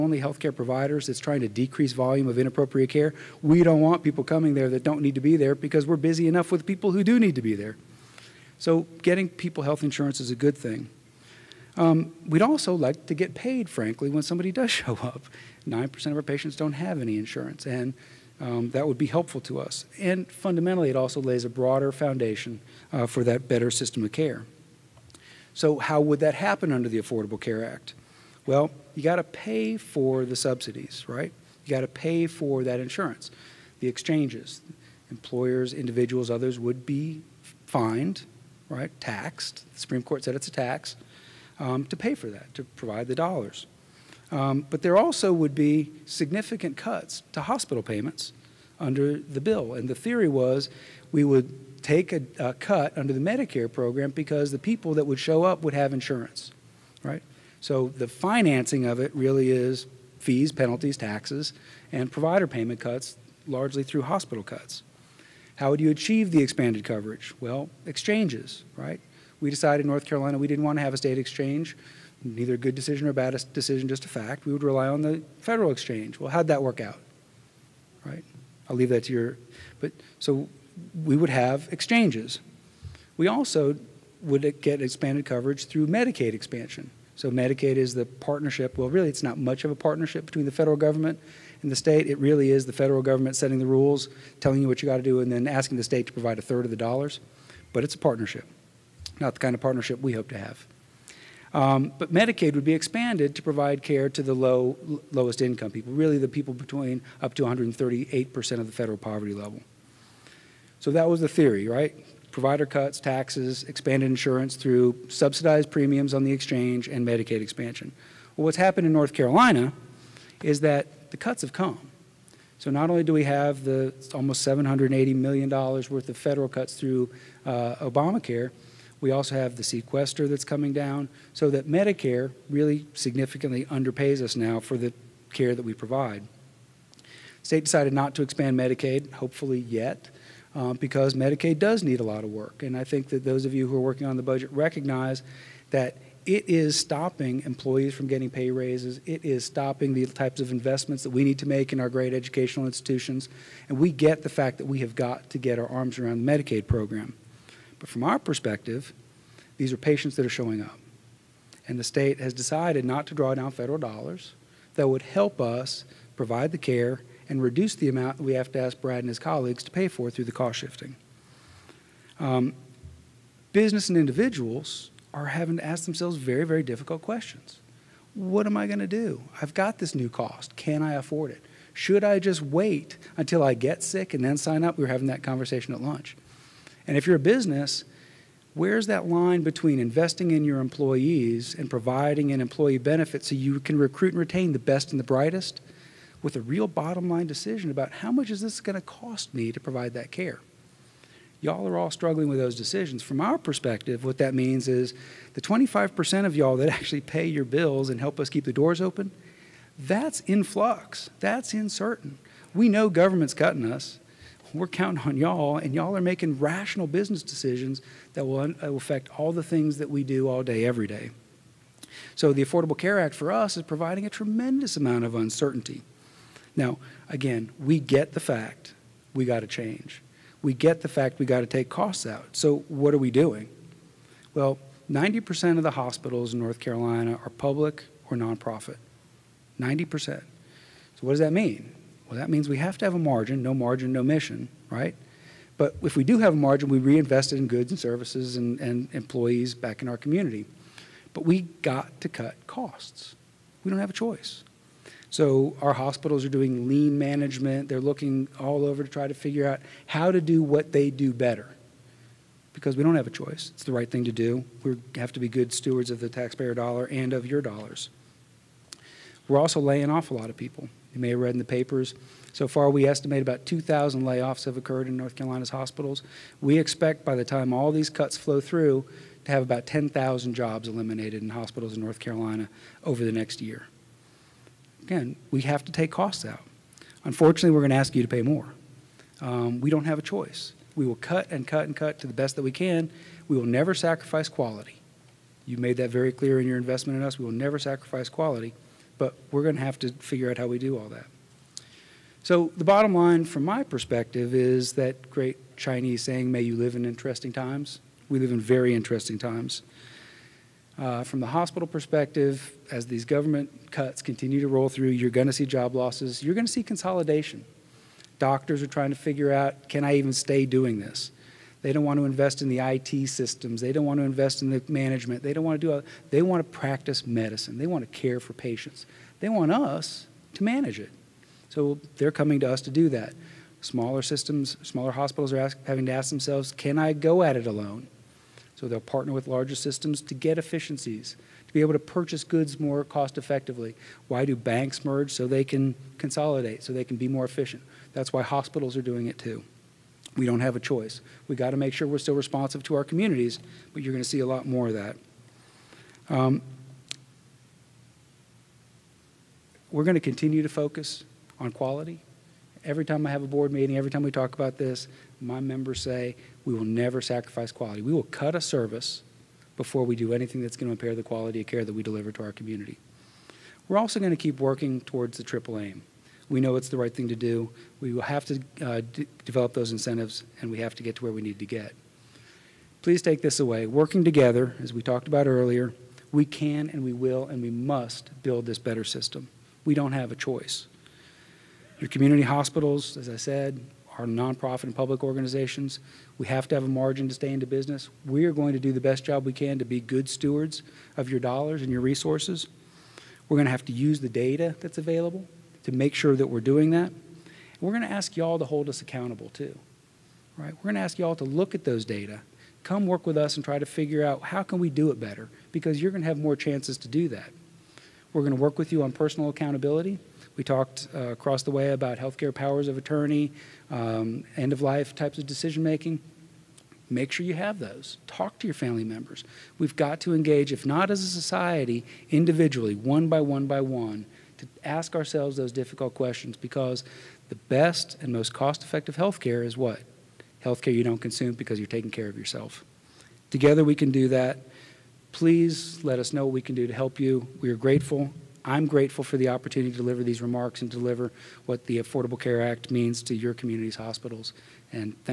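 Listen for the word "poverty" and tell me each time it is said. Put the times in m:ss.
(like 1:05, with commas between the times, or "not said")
1:48.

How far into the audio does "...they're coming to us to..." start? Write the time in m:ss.
5:31.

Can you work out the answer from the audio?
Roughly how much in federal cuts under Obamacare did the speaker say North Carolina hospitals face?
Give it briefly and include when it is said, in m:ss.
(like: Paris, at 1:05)
$780 million, at 2:04.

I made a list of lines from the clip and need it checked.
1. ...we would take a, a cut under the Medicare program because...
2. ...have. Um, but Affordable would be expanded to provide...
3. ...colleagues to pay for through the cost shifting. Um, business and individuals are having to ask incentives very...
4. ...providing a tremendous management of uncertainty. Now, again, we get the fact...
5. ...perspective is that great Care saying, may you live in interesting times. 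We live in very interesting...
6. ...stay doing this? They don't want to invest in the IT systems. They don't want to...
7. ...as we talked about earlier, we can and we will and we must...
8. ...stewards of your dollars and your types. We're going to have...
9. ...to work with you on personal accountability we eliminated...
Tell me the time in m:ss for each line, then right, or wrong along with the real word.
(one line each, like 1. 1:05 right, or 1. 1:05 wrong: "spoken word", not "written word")
1. 0:51 right
2. 1:40 wrong: "Medicaid", not "Affordable"
3. 2:49 wrong: "themselves", not "incentives"
4. 3:43 wrong: "amount", not "management"
5. 5:03 wrong: "Chinese", not "Care"
6. 5:20 right
7. 6:24 right
8. 6:40 wrong: "resources", not "types"
9. 6:58 wrong: "talked", not "eliminated".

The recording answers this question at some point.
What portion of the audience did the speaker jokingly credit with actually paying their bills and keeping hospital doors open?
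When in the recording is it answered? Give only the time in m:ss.
3:25.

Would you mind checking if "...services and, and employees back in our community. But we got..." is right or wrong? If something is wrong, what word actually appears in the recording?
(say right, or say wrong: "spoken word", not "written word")
right.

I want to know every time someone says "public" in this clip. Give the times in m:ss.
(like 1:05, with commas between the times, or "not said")
3:57, 6:34.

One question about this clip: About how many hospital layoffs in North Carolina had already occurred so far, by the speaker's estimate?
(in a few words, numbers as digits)
2,000.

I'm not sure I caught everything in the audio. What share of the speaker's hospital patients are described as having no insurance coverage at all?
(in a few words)
9%.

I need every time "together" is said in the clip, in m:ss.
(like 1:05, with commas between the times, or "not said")
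6:24, 7:23.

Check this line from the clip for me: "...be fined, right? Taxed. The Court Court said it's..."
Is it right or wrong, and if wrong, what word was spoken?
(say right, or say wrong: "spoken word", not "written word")
wrong: "Supreme", not "Court".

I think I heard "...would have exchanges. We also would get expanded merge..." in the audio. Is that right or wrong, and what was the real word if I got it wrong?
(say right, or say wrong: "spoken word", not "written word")
wrong: "coverage", not "merge".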